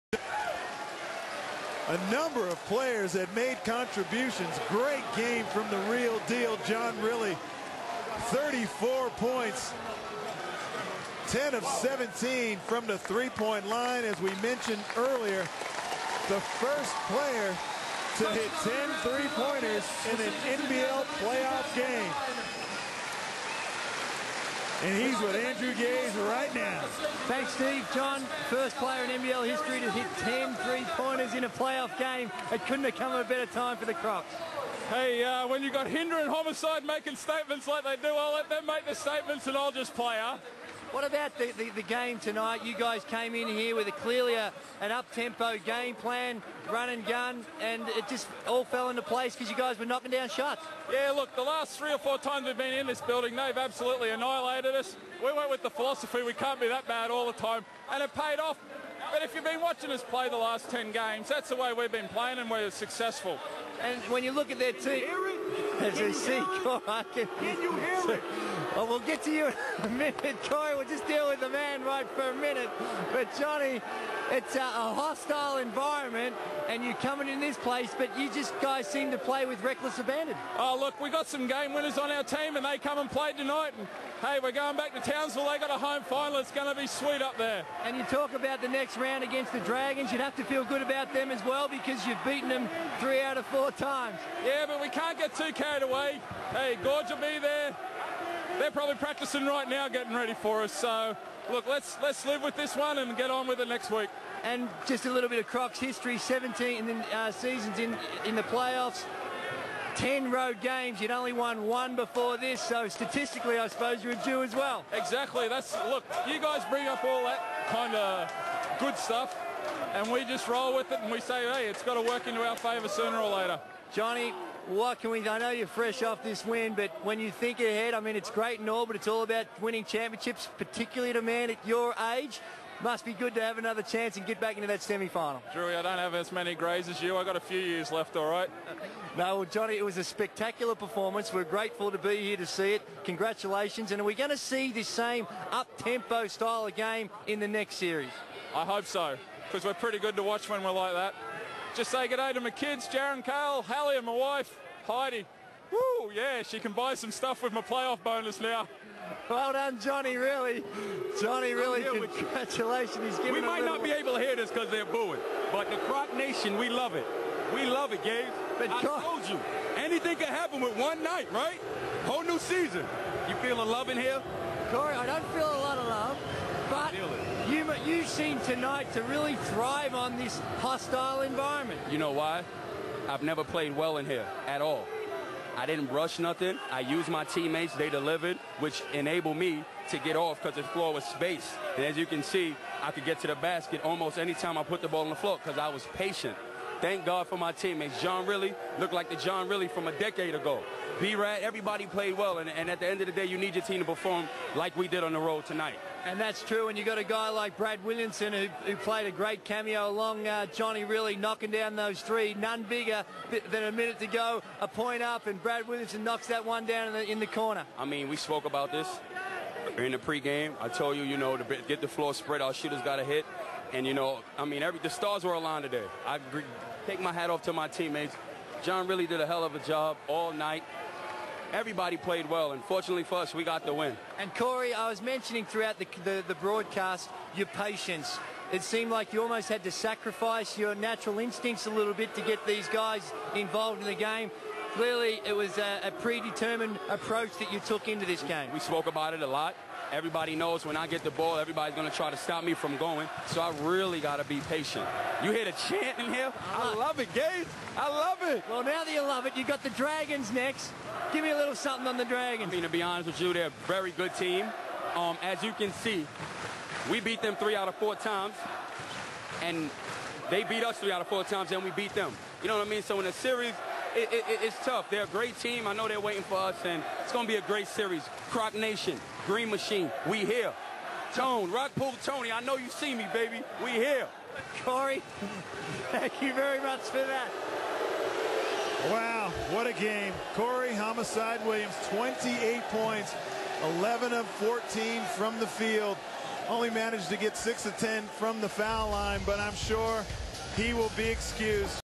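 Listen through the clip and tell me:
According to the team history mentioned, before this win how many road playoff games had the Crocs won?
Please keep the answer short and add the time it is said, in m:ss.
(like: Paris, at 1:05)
1, at 1:50.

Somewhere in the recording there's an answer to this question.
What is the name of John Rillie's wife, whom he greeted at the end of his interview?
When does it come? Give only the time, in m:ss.
2:34.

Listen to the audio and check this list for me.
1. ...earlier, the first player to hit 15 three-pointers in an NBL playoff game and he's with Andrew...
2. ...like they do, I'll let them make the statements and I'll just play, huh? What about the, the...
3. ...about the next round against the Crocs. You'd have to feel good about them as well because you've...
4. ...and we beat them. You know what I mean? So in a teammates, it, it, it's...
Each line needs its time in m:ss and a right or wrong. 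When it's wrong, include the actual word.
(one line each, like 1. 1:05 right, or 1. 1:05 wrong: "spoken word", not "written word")
1. 0:14 wrong: "10", not "15"
2. 0:37 right
3. 1:28 wrong: "Dragons", not "Crocs"
4. 4:31 wrong: "series", not "teammates".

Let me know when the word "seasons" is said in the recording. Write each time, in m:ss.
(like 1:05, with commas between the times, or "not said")
1:47, 2:52.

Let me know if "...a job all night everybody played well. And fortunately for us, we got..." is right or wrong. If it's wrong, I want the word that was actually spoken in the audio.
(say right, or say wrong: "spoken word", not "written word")
right.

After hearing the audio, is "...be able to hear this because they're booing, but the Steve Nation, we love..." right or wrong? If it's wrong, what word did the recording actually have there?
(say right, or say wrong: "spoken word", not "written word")
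wrong: "Croc", not "Steve".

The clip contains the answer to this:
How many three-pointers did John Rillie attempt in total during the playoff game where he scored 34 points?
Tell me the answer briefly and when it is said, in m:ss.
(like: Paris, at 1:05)
17, at 0:11.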